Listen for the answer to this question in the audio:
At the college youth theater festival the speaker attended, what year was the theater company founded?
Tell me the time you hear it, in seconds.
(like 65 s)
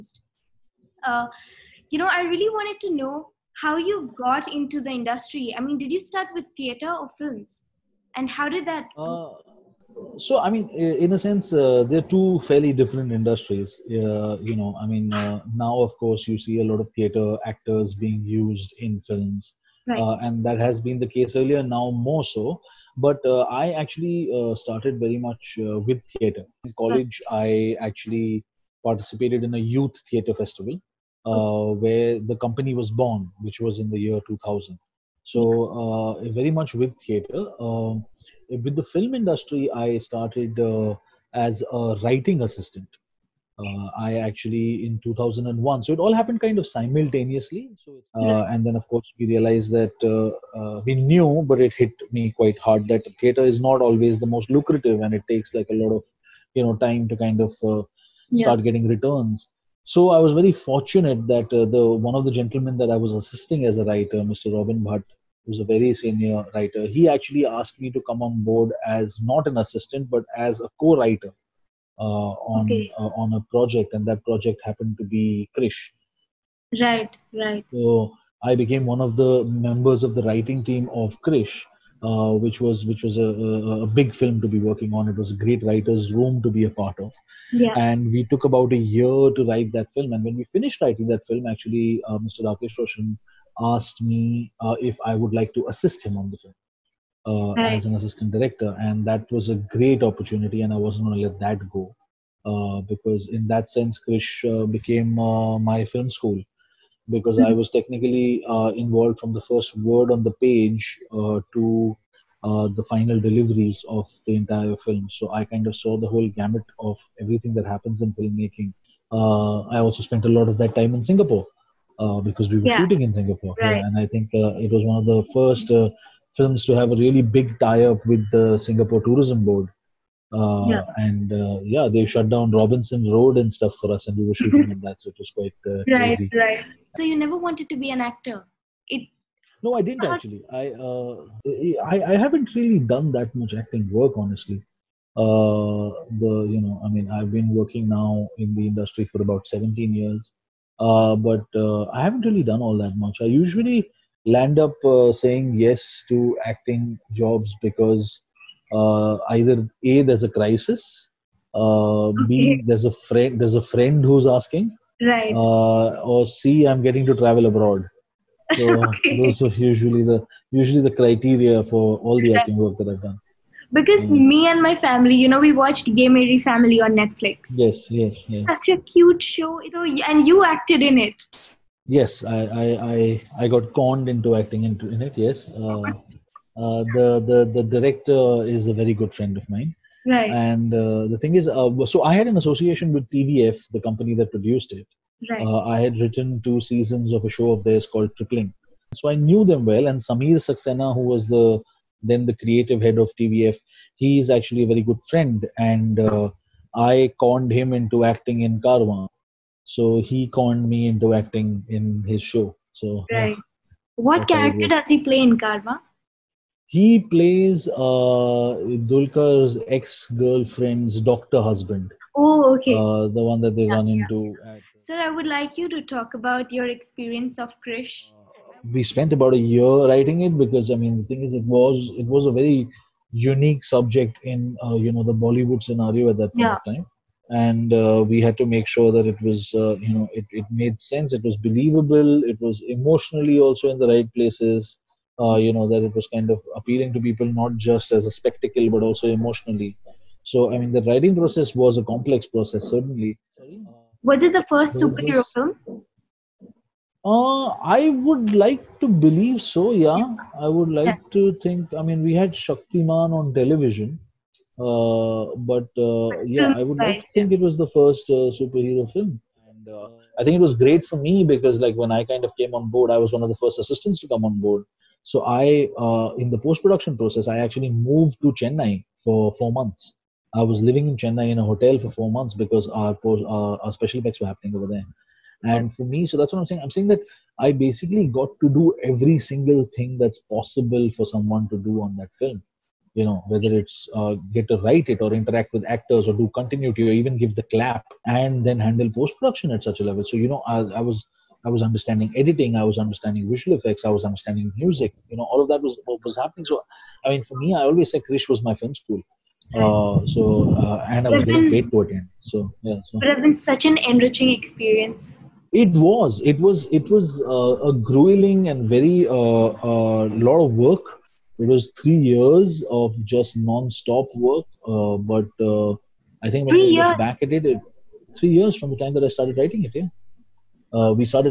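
34 s.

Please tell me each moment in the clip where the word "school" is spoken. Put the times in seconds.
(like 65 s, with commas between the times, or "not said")
106 s, 308 s.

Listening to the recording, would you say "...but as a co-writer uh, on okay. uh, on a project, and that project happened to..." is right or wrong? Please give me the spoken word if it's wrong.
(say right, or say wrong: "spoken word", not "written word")
right.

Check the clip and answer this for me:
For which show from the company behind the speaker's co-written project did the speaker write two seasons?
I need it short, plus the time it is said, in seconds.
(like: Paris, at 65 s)
Tripling, at 198 s.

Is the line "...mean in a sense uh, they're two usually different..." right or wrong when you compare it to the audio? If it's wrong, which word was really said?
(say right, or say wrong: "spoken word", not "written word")
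wrong: "fairly", not "usually".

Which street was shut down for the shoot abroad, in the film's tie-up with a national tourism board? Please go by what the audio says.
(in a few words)
Robinson Road.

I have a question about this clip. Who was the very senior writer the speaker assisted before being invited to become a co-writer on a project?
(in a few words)
Robin Bhatt.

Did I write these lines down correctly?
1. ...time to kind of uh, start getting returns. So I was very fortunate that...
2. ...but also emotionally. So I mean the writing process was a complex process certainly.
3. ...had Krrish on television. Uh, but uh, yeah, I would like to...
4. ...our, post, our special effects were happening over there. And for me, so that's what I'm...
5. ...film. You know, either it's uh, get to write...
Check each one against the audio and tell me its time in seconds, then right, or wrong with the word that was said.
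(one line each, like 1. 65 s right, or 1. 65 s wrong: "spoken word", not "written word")
1. 56 s right
2. 248 s right
3. 262 s wrong: "Shaktiman", not "Krrish"
4. 282 s right
5. 292 s wrong: "whether", not "either".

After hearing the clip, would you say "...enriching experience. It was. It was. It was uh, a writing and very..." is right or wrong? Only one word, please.
wrong.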